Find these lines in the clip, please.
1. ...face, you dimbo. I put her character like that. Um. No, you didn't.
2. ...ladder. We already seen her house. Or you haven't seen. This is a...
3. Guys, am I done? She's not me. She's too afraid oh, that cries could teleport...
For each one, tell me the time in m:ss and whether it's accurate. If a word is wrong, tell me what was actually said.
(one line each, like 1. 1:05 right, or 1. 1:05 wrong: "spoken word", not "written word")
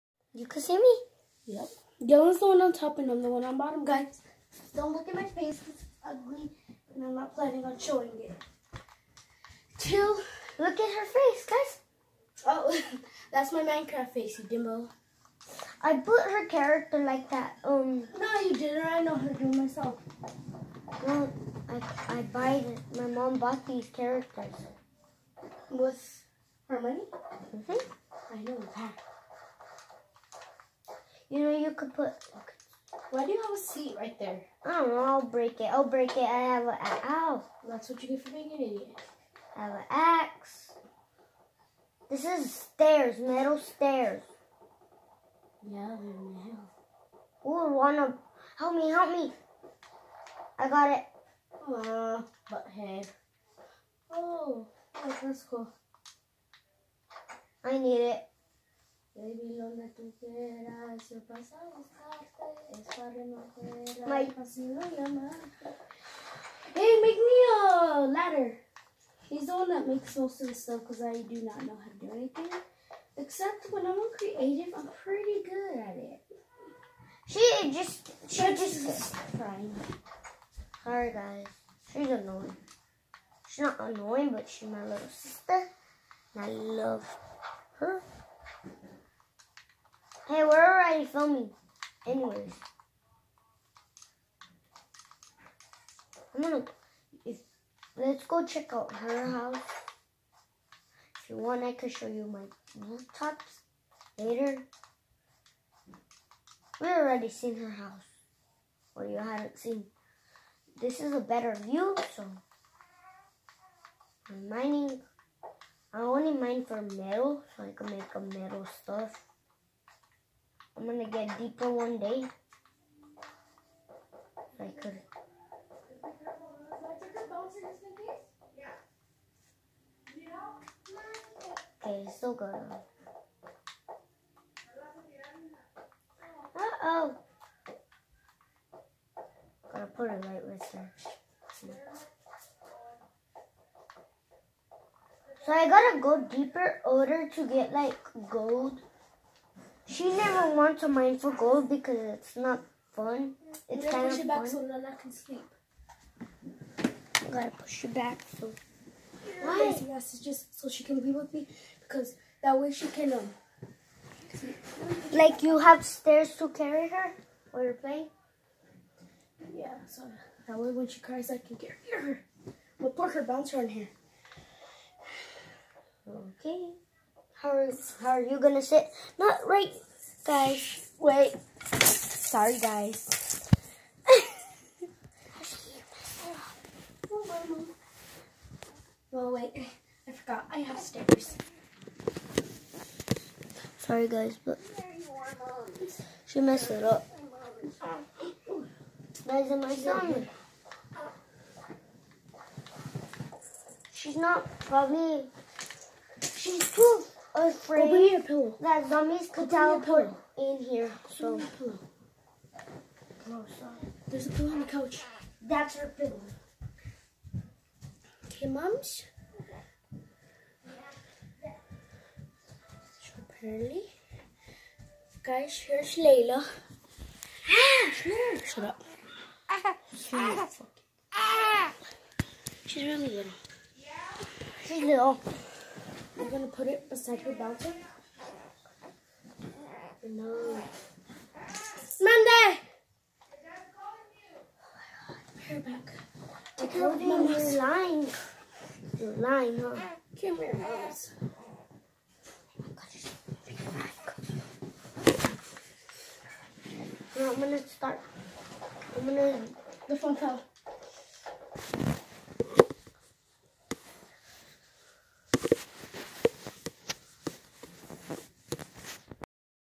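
1. 0:14 right
2. 1:44 wrong: "later", not "ladder"
3. 3:19 wrong: "zombies", not "cries".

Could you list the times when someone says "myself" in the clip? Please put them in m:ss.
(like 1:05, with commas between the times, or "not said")
0:19.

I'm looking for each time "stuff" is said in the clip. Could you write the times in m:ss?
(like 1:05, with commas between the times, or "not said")
1:10, 1:58.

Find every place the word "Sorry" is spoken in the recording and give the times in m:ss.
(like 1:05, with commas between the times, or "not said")
1:20, 3:01, 3:13.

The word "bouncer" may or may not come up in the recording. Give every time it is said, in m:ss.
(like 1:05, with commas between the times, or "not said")
2:53, 3:57.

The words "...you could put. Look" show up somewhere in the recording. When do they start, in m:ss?
0:31.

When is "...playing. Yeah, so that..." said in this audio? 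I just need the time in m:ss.
2:47.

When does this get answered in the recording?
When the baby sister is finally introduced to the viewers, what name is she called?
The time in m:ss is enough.
3:45.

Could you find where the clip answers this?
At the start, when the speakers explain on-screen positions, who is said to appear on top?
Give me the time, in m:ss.
0:02.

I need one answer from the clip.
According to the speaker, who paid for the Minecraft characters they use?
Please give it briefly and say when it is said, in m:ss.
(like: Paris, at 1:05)
My mom, at 0:22.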